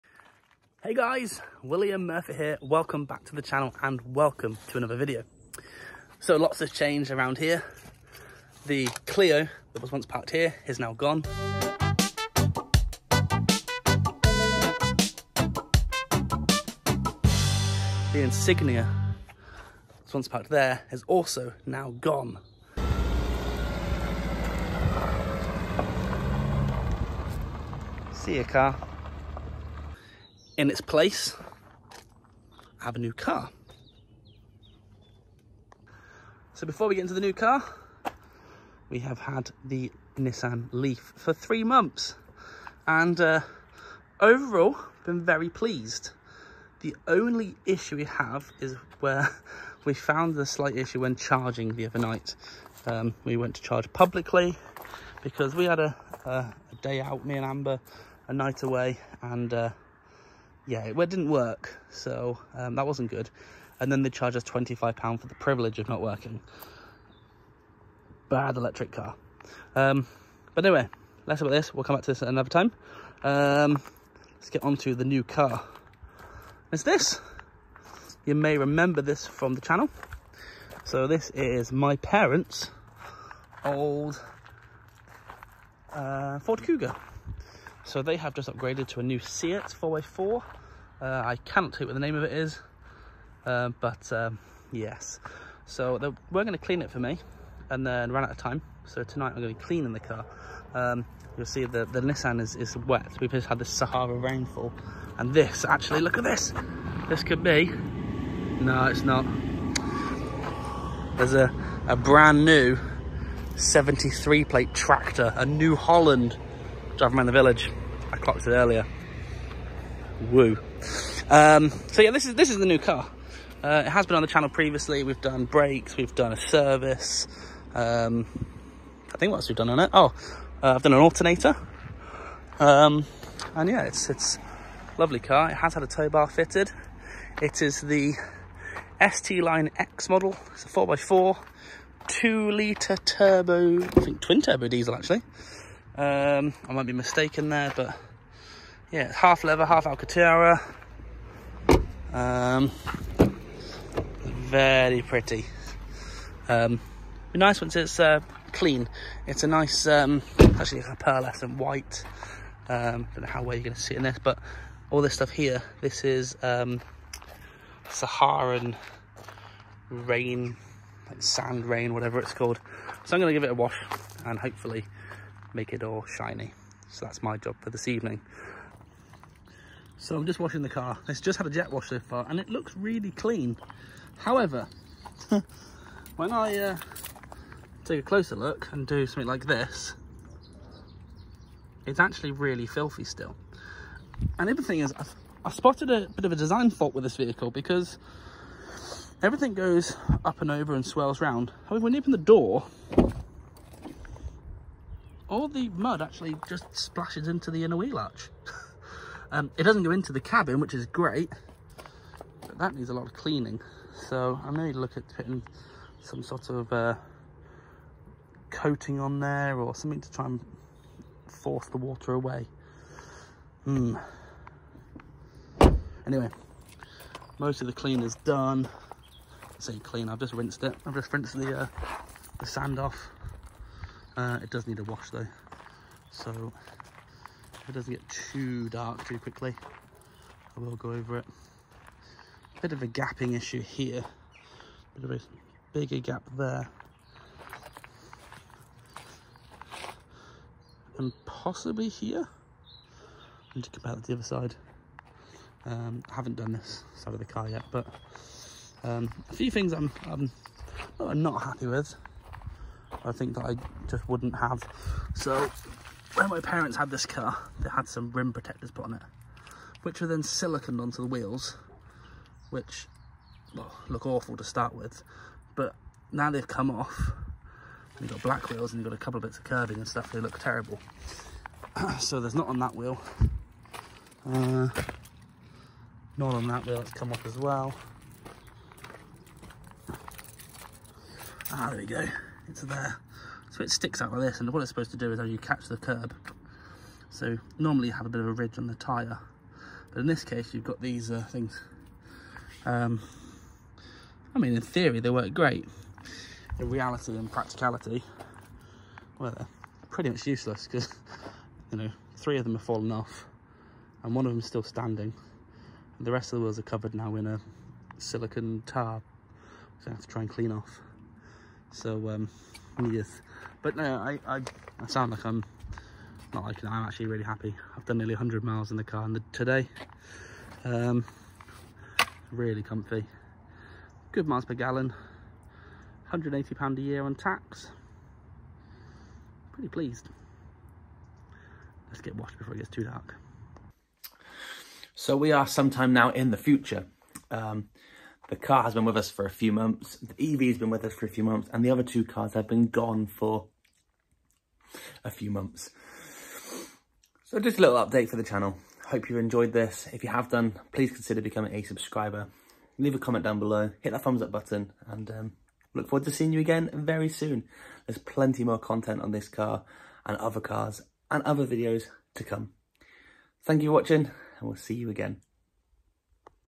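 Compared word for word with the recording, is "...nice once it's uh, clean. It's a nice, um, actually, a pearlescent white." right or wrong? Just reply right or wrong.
right.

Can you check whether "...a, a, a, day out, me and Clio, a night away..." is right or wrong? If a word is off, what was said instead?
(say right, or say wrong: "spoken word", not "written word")
wrong: "Amber", not "Clio".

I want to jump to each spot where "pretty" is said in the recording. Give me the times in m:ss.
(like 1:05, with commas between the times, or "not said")
2:35, 5:09, 5:39.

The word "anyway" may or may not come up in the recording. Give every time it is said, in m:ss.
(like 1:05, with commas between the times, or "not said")
1:10, 3:46.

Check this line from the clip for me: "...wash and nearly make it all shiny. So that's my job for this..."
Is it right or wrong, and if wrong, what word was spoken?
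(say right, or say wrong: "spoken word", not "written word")
wrong: "hopefully", not "nearly".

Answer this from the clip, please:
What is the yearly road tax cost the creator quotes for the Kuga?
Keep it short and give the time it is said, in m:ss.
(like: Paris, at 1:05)
£180, at 5:36.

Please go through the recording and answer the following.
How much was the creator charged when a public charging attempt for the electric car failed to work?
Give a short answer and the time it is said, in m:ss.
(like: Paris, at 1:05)
£25, at 1:04.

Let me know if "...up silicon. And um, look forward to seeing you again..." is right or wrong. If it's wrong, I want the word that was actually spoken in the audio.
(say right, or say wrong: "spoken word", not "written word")
wrong: "button", not "silicon".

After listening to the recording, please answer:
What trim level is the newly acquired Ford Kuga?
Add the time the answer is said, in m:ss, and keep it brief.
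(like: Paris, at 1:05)
ST Line X, at 2:19.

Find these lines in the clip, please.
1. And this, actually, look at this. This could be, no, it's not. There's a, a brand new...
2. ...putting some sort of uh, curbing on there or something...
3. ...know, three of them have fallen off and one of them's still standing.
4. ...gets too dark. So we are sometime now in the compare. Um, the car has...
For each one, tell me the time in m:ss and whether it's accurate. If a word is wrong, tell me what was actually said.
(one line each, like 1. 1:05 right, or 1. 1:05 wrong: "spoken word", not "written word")
1. 1:45 right
2. 3:35 wrong: "coating", not "curbing"
3. 5:11 right
4. 5:42 wrong: "future", not "compare".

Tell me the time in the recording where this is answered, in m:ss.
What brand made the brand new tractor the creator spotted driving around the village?
1:55.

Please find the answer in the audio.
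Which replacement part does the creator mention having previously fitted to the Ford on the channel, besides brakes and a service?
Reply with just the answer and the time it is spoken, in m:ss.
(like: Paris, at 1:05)
alternator, at 2:10.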